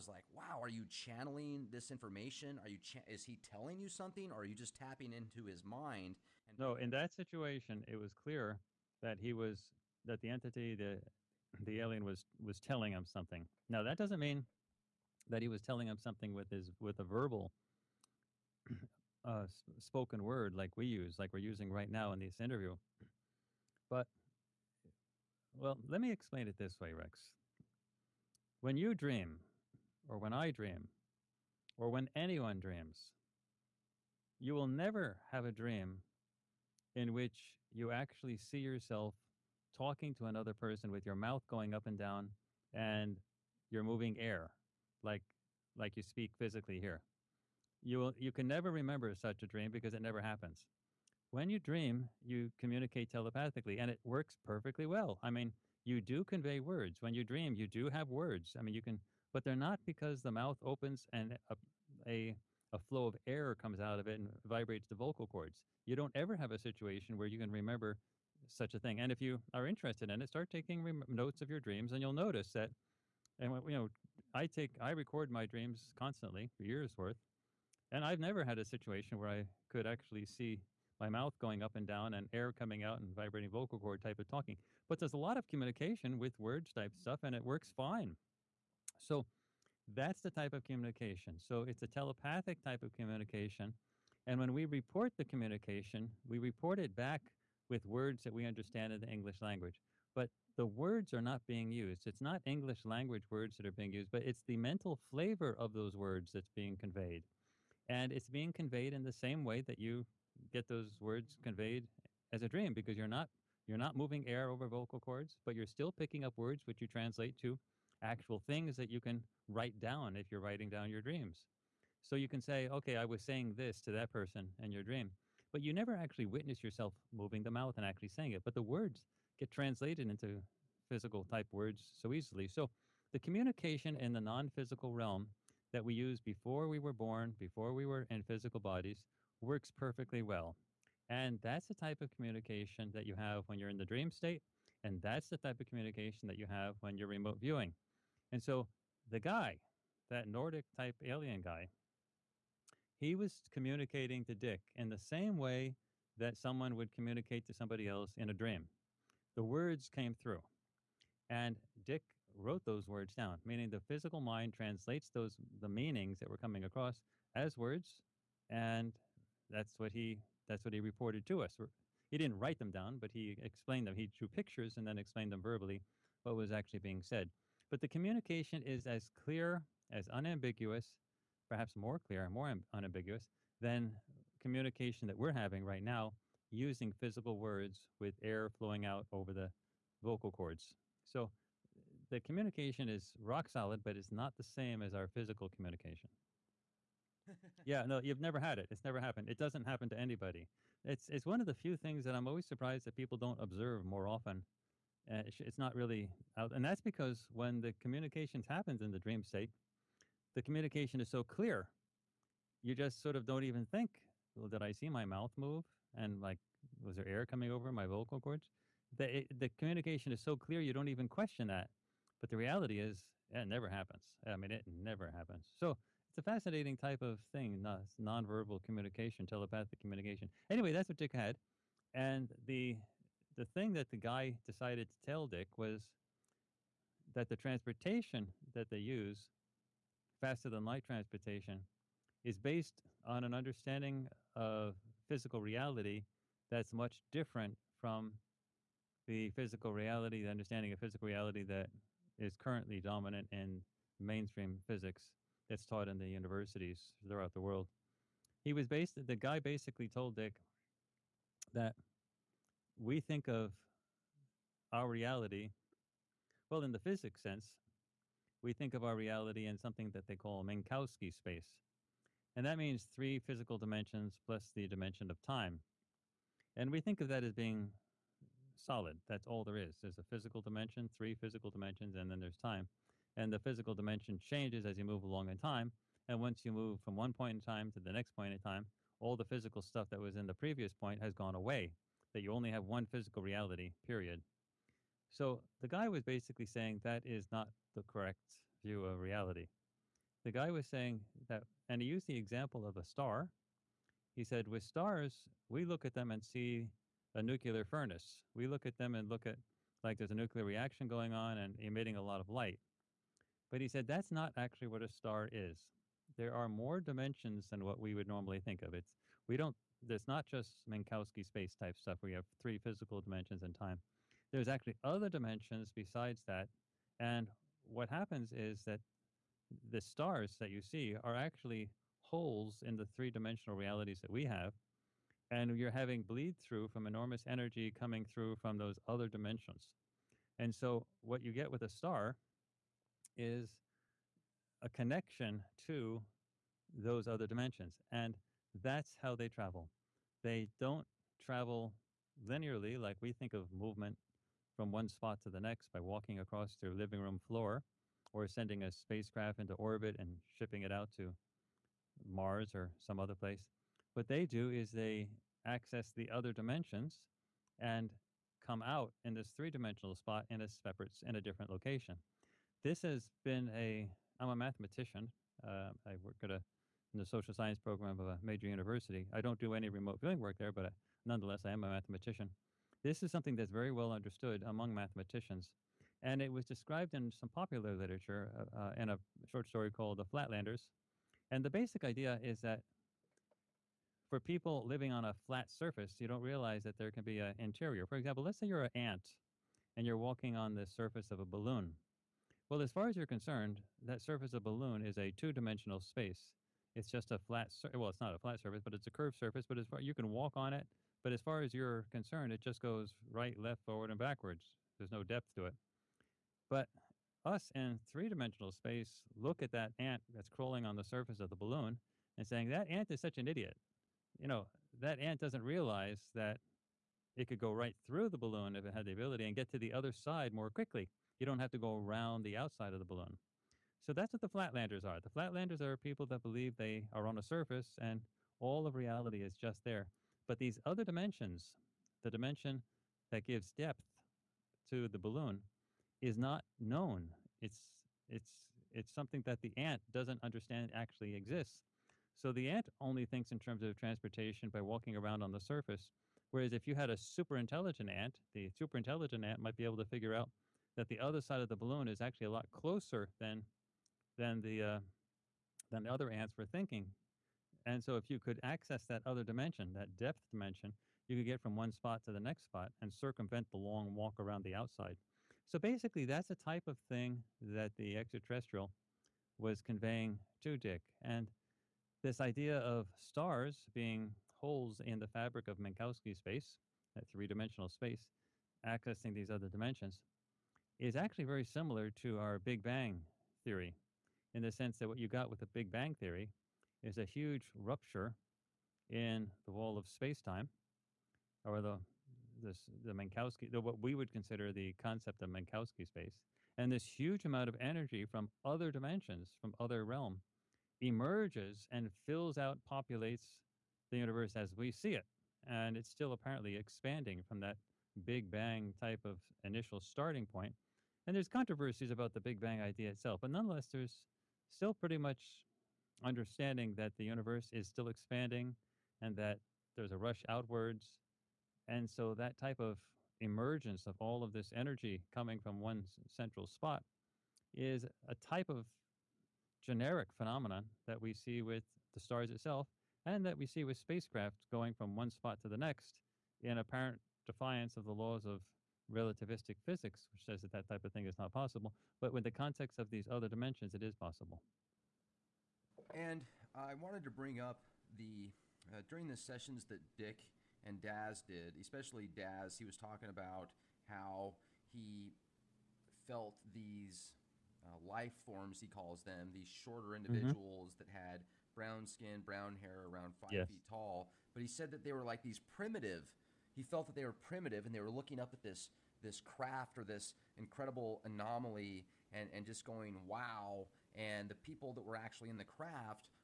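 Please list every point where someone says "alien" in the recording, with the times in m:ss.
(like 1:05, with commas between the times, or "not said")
0:11, 2:31.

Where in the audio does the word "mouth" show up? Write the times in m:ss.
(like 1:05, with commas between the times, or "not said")
0:41, 1:00, 1:21, 2:07, 3:35.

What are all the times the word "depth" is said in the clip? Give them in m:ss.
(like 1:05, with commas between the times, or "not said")
6:55, 7:23, 7:49.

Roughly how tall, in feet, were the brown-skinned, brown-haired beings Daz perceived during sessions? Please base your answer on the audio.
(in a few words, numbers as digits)
5 feet.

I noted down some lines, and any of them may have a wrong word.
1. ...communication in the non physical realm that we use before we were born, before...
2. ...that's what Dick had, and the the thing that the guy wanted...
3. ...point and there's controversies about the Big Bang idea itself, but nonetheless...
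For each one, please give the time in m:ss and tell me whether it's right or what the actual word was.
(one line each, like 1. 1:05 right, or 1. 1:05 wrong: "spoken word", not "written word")
1. 2:13 right
2. 3:50 wrong: "decided", not "wanted"
3. 8:40 right.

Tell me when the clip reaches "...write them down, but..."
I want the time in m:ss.
2:52.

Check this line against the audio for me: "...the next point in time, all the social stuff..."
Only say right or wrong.
wrong.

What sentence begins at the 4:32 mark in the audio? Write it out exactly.
And that means three physical dimensions plus the dimension of time.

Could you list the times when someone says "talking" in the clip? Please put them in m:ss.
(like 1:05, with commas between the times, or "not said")
0:39, 1:24, 9:22.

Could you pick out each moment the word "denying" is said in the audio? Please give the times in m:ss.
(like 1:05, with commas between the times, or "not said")
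not said.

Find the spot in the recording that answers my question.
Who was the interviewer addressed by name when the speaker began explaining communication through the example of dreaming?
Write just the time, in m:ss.
0:26.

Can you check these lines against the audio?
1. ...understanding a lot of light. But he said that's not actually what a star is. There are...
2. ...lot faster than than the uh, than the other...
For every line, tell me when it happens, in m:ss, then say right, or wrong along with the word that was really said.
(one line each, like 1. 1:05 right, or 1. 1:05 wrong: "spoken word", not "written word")
1. 5:11 wrong: "emitting", not "understanding"
2. 7:42 wrong: "closer", not "faster".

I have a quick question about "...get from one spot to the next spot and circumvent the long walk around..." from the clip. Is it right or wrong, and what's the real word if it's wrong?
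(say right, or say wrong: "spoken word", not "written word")
right.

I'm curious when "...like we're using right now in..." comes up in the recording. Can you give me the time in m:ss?
0:21.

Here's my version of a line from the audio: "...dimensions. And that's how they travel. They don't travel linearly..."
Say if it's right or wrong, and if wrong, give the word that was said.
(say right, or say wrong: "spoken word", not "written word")
right.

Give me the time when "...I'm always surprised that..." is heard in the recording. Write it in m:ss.
3:22.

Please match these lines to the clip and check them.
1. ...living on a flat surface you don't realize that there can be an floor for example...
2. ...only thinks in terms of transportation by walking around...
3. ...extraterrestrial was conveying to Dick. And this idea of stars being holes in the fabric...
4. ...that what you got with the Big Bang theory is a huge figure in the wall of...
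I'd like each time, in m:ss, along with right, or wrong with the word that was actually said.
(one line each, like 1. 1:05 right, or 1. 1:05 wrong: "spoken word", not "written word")
1. 6:34 wrong: "interior", not "floor"
2. 7:32 right
3. 7:57 right
4. 8:14 wrong: "rupture", not "figure".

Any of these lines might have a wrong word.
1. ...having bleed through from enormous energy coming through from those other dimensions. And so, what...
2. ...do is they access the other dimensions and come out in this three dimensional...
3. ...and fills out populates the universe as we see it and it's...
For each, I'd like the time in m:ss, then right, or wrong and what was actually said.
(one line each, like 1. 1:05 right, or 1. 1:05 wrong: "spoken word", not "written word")
1. 5:35 right
2. 6:04 right
3. 8:31 right.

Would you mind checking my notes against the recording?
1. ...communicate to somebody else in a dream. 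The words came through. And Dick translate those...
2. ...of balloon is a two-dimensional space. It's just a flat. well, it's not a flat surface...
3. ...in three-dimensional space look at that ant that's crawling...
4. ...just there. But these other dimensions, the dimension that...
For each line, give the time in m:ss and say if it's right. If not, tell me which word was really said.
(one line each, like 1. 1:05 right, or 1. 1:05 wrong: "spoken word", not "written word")
1. 2:36 wrong: "wrote", not "translate"
2. 6:44 right
3. 6:57 right
4. 7:19 right.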